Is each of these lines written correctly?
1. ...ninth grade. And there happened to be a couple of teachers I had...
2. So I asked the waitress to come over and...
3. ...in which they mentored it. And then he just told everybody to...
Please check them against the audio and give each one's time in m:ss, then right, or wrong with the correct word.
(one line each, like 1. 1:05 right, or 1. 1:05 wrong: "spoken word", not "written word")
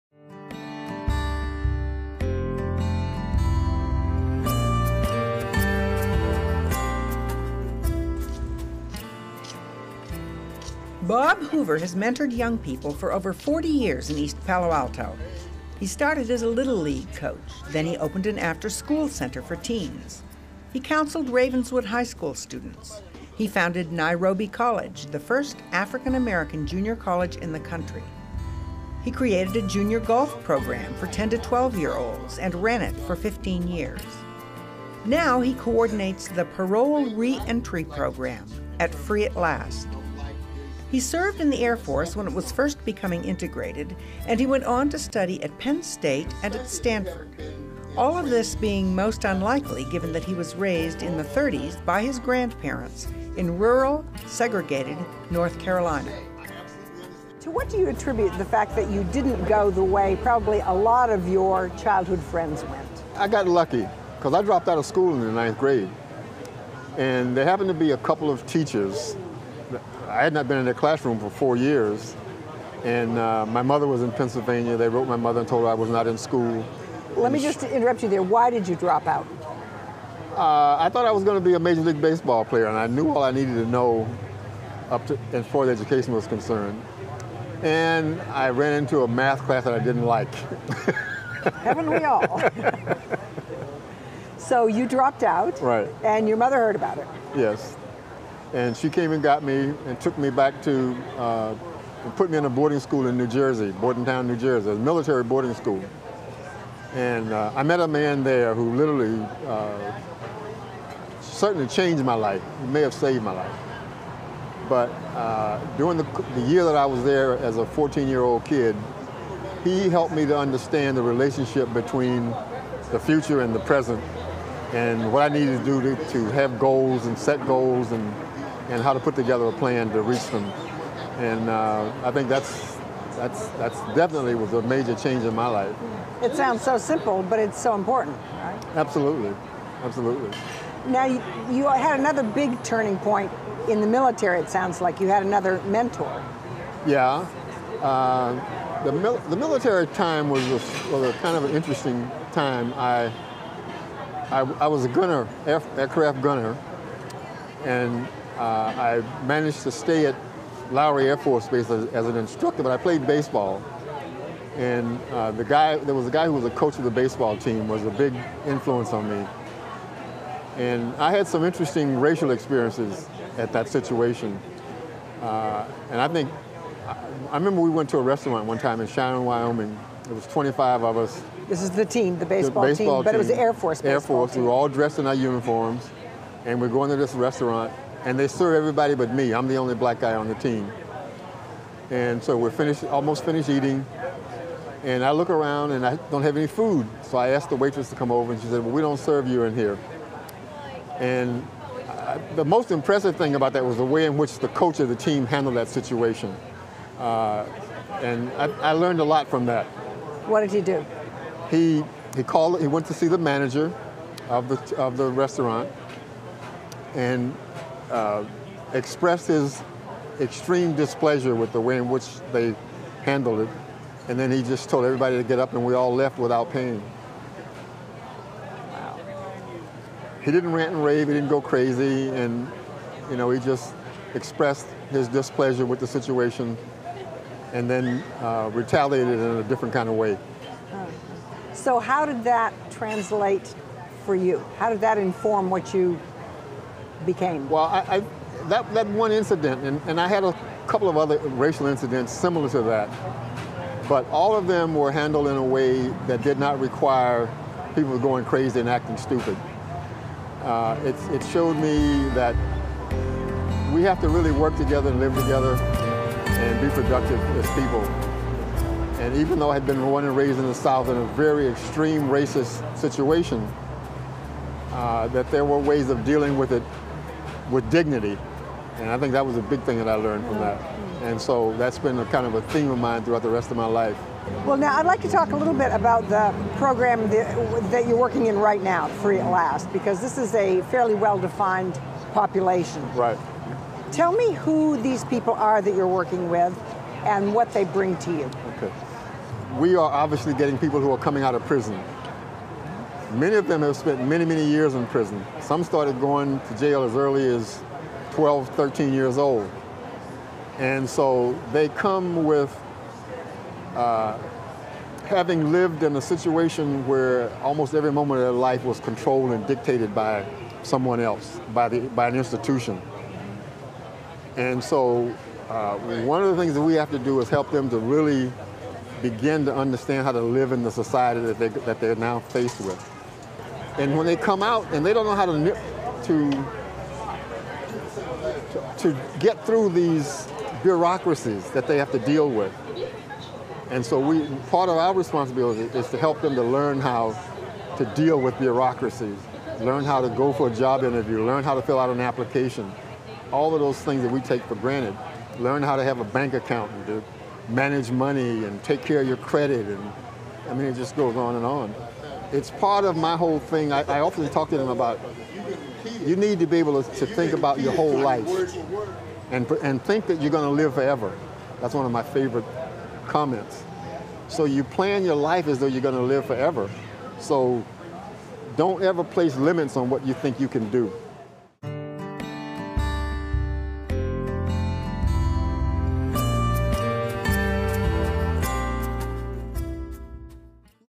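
1. 1:05 right
2. 3:17 right
3. 3:41 wrong: "handled", not "mentored".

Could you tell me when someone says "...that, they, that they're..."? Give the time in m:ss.
5:31.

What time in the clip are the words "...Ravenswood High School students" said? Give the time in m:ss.
0:21.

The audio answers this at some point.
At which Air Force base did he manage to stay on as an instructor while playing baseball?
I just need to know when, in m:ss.
2:40.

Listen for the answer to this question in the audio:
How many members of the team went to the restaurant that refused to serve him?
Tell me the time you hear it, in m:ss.
3:00.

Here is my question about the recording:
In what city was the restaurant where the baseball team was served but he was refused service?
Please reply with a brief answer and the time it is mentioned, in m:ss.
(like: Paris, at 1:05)
Cheyenne, Wyoming, at 2:58.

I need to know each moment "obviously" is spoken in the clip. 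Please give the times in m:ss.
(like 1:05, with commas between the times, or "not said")
4:59.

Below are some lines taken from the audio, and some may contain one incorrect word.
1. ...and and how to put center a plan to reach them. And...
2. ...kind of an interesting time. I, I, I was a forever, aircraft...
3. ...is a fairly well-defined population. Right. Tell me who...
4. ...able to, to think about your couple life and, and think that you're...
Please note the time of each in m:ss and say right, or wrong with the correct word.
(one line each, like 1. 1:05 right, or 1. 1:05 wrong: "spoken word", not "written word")
1. 2:07 wrong: "together", not "center"
2. 2:31 wrong: "gunner", not "forever"
3. 4:50 right
4. 6:06 wrong: "whole", not "couple".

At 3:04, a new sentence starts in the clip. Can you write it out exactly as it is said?
we were all dressed in our uniforms, and we're going to this restaurant, and they serve everybody but me.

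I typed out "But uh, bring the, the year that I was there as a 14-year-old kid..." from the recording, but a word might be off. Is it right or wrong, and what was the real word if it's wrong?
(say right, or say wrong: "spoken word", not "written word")
wrong: "during", not "bring".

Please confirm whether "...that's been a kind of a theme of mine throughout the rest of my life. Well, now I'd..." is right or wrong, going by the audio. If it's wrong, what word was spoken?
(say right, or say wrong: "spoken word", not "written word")
right.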